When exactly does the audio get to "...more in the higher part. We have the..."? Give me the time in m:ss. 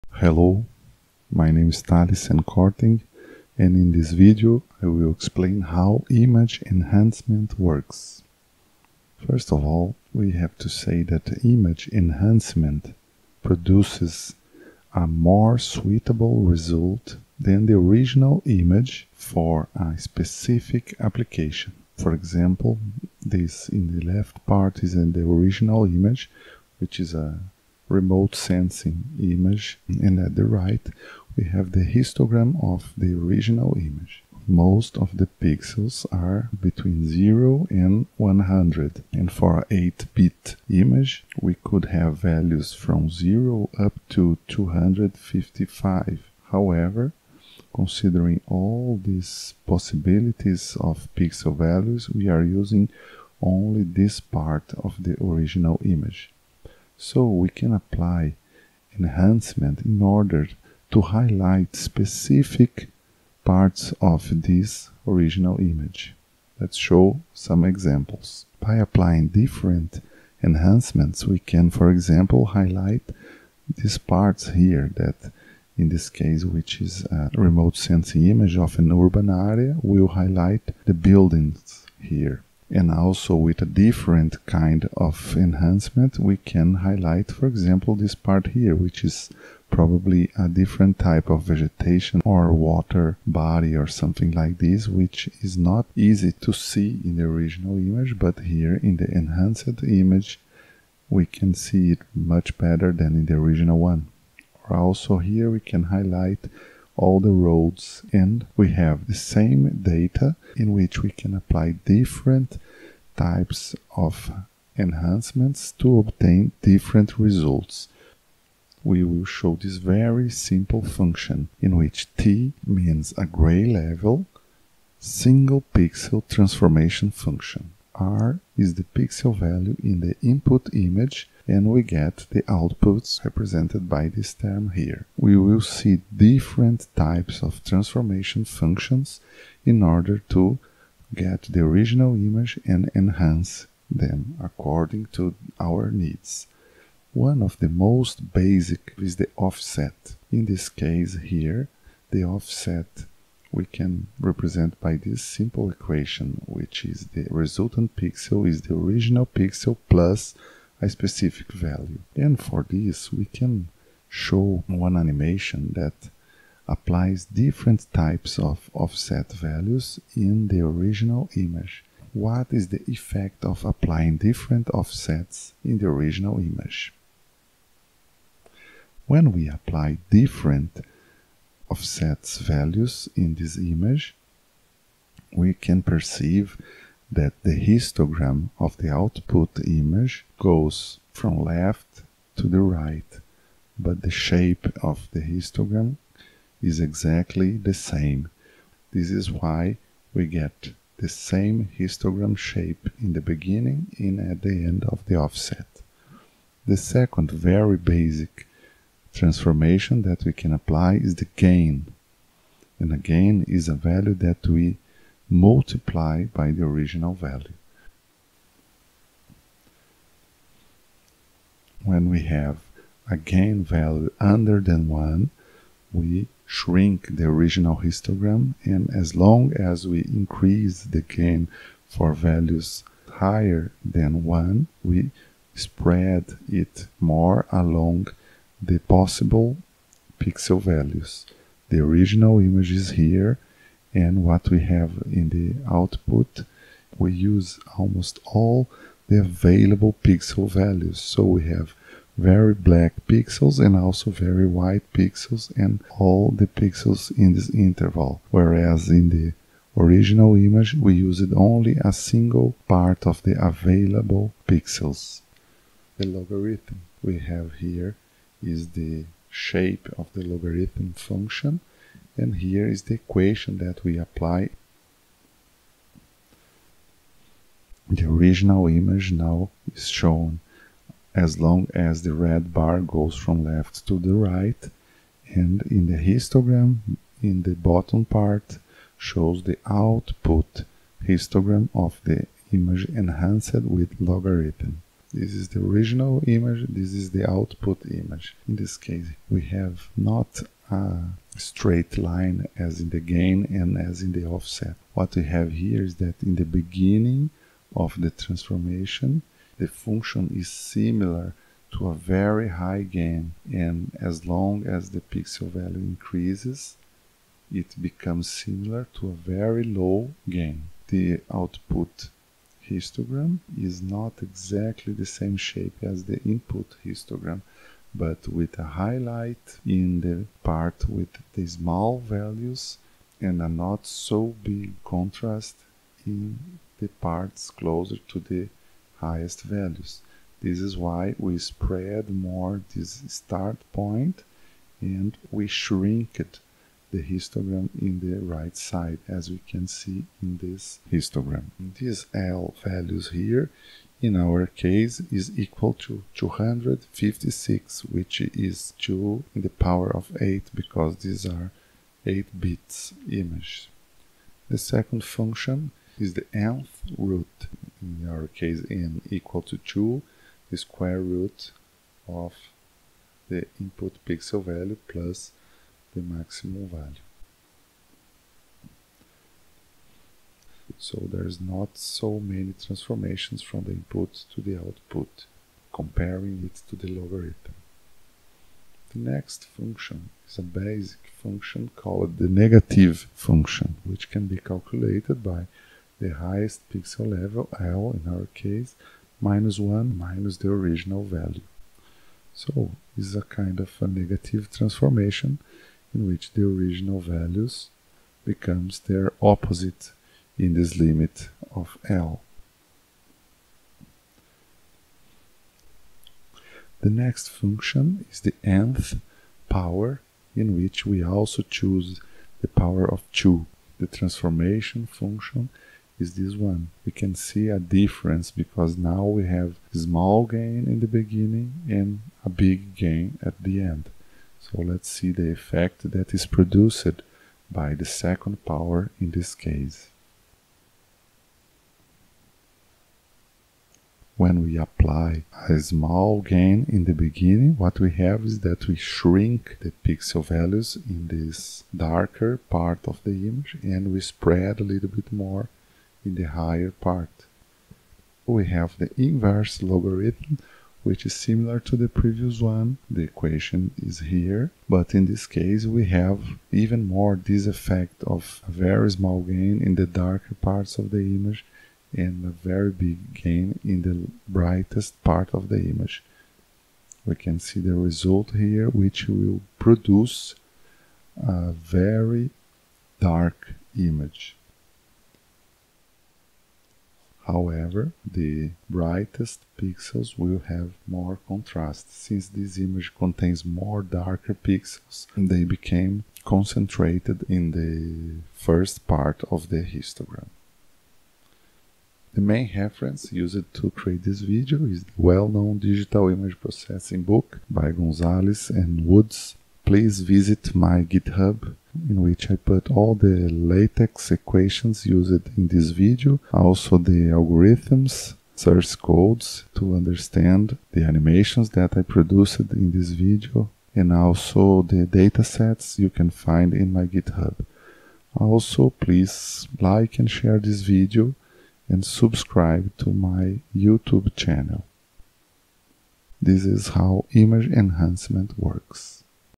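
7:35.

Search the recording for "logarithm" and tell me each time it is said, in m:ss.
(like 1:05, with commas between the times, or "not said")
4:26, 4:30, 4:53, 6:26, 7:39.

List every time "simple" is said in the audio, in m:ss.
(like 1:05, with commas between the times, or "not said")
2:00, 2:35.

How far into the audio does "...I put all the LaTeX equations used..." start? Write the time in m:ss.
8:32.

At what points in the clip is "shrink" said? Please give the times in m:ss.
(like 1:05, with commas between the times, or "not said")
3:46, 7:28.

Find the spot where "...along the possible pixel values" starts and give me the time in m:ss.
3:57.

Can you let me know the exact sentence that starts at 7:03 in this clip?
The transformation function is this one.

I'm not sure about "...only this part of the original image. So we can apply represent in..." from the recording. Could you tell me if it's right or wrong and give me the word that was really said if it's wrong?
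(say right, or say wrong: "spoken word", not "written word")
wrong: "enhancement", not "represent".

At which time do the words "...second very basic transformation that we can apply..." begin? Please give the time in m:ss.
3:26.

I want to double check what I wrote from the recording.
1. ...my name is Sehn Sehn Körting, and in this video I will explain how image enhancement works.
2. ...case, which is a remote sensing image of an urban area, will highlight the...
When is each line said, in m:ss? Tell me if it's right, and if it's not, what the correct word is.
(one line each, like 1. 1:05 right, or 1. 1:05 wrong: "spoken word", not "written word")
1. 0:01 wrong: "Thales", not "Sehn"
2. 1:16 right.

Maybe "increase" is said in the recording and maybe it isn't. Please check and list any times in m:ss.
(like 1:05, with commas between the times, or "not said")
3:50, 5:15.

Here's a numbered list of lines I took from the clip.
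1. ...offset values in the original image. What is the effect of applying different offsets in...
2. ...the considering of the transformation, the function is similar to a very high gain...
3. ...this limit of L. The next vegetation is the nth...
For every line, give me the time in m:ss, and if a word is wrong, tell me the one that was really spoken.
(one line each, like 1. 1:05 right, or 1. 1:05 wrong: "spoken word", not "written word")
1. 2:48 right
2. 5:06 wrong: "beginning", not "considering"
3. 6:50 wrong: "function", not "vegetation".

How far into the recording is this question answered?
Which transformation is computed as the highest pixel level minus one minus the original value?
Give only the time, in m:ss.
6:32.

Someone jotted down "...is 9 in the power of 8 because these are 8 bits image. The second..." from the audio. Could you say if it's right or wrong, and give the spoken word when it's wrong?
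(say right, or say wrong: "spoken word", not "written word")
wrong: "2", not "9".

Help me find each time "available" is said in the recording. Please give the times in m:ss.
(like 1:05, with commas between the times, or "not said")
4:09, 4:23.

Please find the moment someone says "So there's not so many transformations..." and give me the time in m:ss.
6:20.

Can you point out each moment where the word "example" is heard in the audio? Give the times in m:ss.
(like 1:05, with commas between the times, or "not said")
0:22, 1:07, 1:11, 1:27.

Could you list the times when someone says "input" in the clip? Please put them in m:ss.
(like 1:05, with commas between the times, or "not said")
2:10, 5:26, 6:13, 6:23.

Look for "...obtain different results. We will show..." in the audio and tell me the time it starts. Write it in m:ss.
1:55.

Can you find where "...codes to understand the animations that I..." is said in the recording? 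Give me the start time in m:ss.
8:38.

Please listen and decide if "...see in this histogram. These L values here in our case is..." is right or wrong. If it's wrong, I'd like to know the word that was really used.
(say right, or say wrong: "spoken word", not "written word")
right.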